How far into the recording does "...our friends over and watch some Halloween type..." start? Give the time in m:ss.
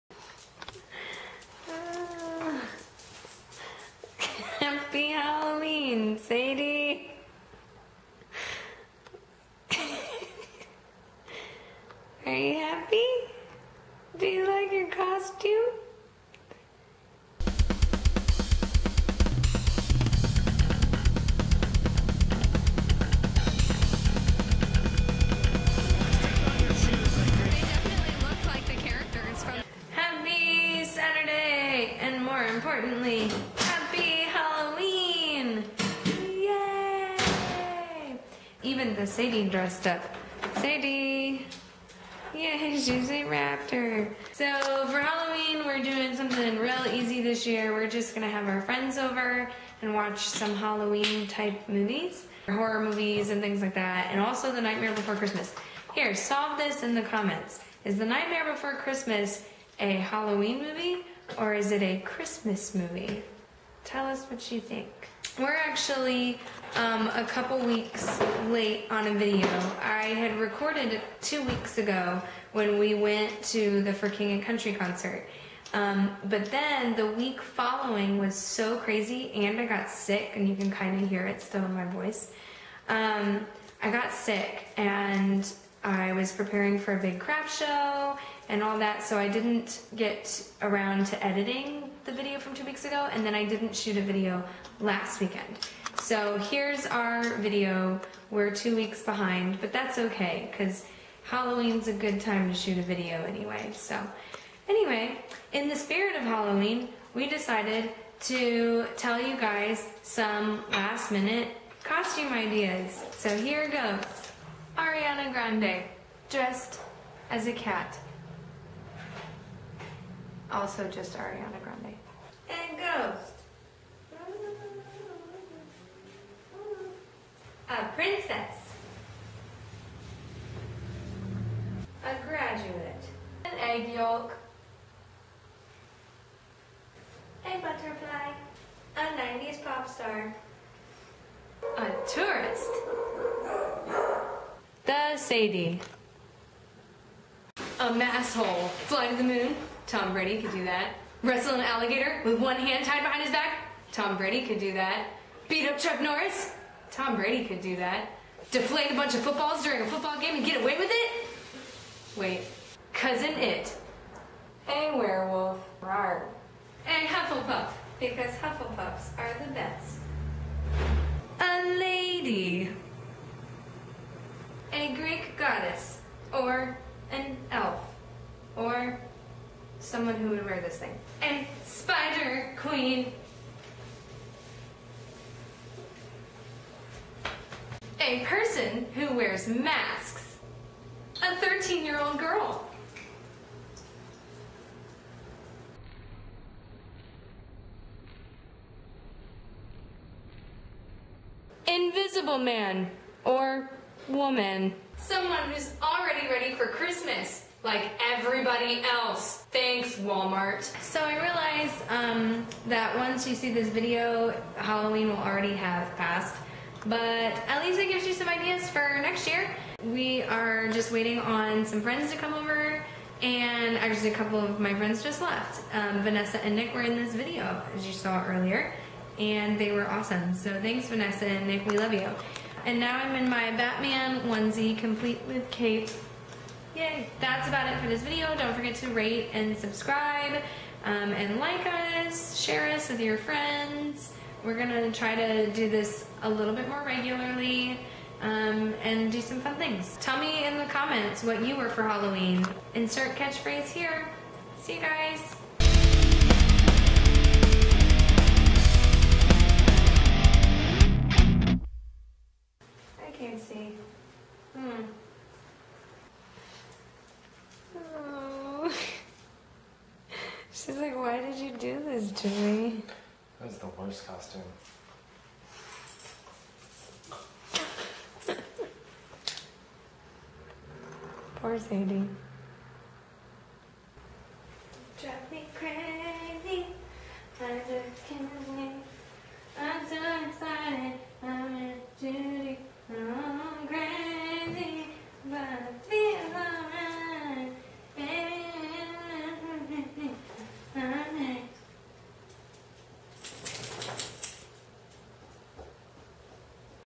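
0:48.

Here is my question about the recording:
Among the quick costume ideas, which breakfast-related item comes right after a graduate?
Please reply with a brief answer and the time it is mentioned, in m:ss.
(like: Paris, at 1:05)
An egg yolk, at 2:13.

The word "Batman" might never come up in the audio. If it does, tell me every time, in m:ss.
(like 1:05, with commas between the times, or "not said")
3:53.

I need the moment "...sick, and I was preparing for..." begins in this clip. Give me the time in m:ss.
1:24.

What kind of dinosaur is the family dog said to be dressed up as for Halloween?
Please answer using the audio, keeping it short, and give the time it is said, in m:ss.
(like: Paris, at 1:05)
Raptor, at 0:43.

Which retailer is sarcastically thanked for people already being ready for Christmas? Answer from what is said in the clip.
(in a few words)
Walmart.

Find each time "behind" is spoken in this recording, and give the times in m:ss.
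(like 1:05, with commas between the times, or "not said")
1:39, 2:33.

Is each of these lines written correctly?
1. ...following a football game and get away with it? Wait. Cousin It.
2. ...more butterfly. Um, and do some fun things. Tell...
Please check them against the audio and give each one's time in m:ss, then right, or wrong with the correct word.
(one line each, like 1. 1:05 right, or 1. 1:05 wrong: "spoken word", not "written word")
1. 2:39 wrong: "during", not "following"
2. 4:06 wrong: "regularly", not "butterfly".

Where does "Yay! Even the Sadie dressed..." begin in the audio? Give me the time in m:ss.
0:36.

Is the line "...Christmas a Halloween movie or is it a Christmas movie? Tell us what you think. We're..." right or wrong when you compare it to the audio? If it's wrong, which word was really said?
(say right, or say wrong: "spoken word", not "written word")
right.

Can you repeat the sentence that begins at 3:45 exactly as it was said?
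Um, Vanessa and Nick were in this video, as you saw earlier, and they were awesome.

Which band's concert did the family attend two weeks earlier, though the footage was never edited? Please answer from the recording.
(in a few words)
For King and Country.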